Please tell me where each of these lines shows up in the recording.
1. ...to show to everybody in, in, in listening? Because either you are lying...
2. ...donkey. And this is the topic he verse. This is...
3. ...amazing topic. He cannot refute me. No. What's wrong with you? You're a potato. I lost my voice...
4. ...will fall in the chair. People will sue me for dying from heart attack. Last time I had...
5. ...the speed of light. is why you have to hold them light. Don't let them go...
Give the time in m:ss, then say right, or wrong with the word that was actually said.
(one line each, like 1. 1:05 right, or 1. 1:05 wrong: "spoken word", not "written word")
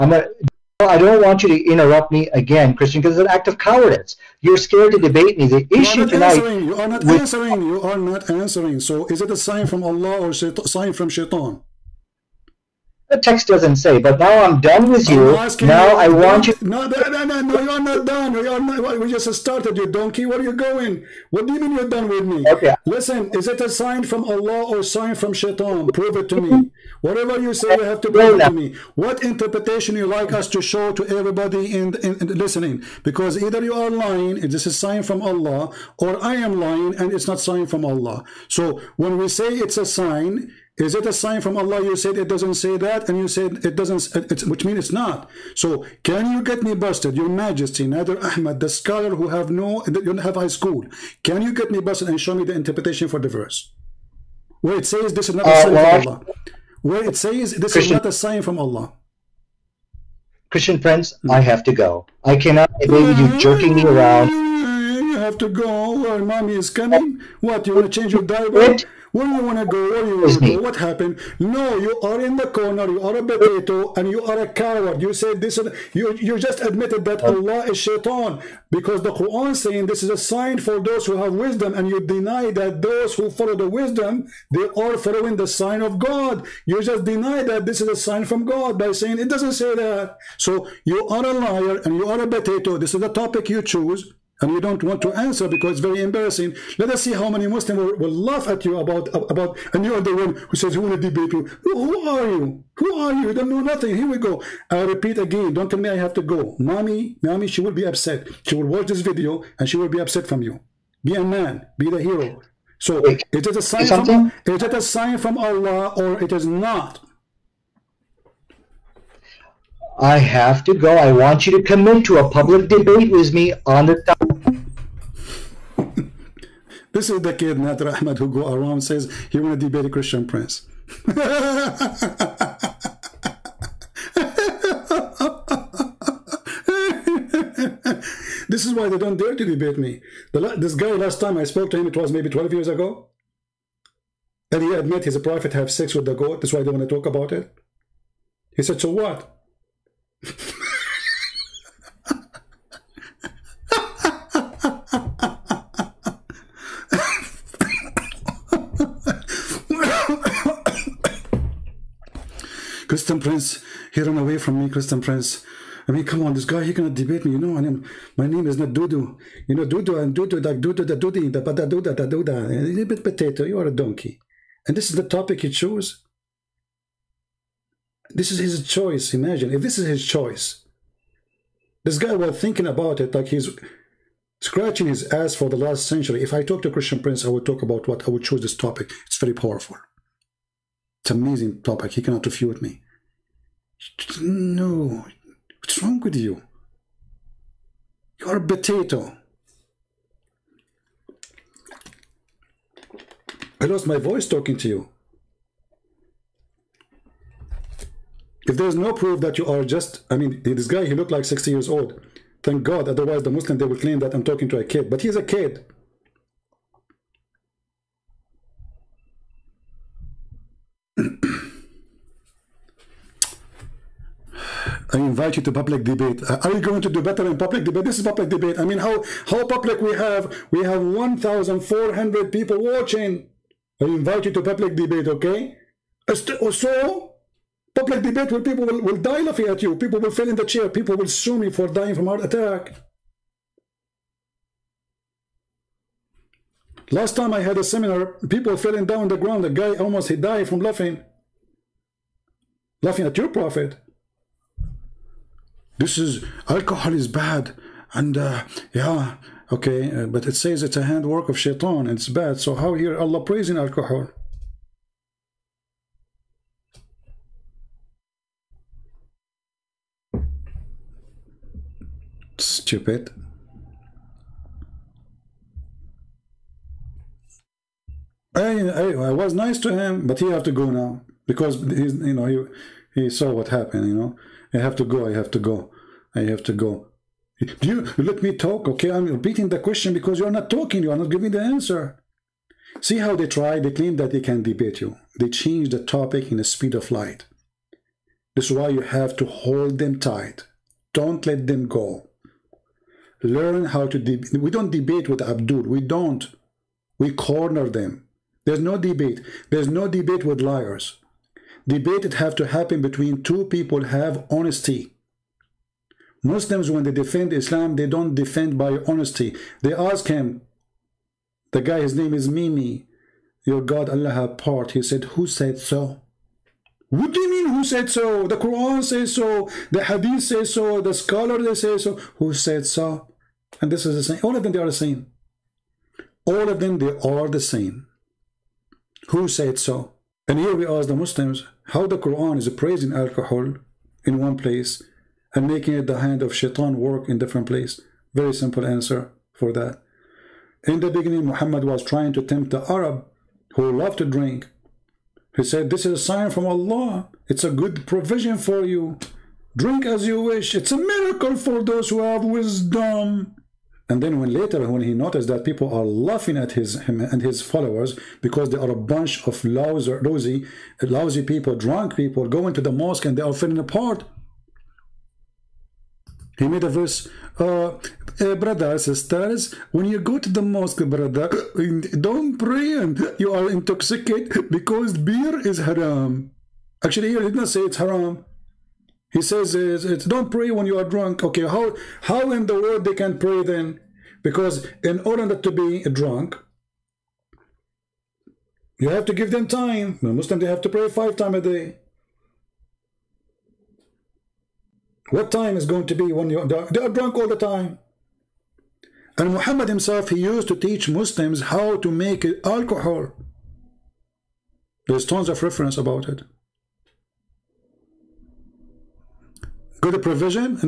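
1. 0:30 right
2. 2:53 wrong: "chose", not "verse"
3. 3:11 right
4. 3:59 right
5. 4:56 wrong: "tight", not "light".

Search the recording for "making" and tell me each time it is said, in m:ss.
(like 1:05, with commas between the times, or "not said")
5:45.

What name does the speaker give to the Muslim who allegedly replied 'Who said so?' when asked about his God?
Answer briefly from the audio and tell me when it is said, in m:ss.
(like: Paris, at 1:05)
Mimi, at 5:22.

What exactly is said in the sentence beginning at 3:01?
This guy was thinking about it like he's scratching his ass for the last century.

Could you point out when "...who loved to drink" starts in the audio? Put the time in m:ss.
5:53.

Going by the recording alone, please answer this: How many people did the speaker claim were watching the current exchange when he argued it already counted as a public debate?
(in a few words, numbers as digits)
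1,400.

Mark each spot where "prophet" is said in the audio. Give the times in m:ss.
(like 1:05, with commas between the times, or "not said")
2:25, 4:13.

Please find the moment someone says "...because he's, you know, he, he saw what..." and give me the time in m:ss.
4:41.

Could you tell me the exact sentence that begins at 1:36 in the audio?
Let us see how many Muslims will, will laugh at you about about.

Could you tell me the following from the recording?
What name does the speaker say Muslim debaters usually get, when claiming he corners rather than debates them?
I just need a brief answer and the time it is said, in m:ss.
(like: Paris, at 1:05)
Abdul, at 5:05.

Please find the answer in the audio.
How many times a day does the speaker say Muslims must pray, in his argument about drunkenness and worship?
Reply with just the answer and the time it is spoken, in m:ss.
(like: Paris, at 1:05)
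5, at 6:40.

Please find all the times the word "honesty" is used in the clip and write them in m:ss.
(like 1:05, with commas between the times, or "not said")
5:14, 5:18.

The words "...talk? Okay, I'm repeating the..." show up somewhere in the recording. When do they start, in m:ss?
4:48.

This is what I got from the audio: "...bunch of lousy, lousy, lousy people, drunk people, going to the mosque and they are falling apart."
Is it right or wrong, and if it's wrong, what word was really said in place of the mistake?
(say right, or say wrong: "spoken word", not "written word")
right.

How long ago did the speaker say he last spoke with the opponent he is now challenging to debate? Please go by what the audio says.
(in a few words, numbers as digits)
12 years.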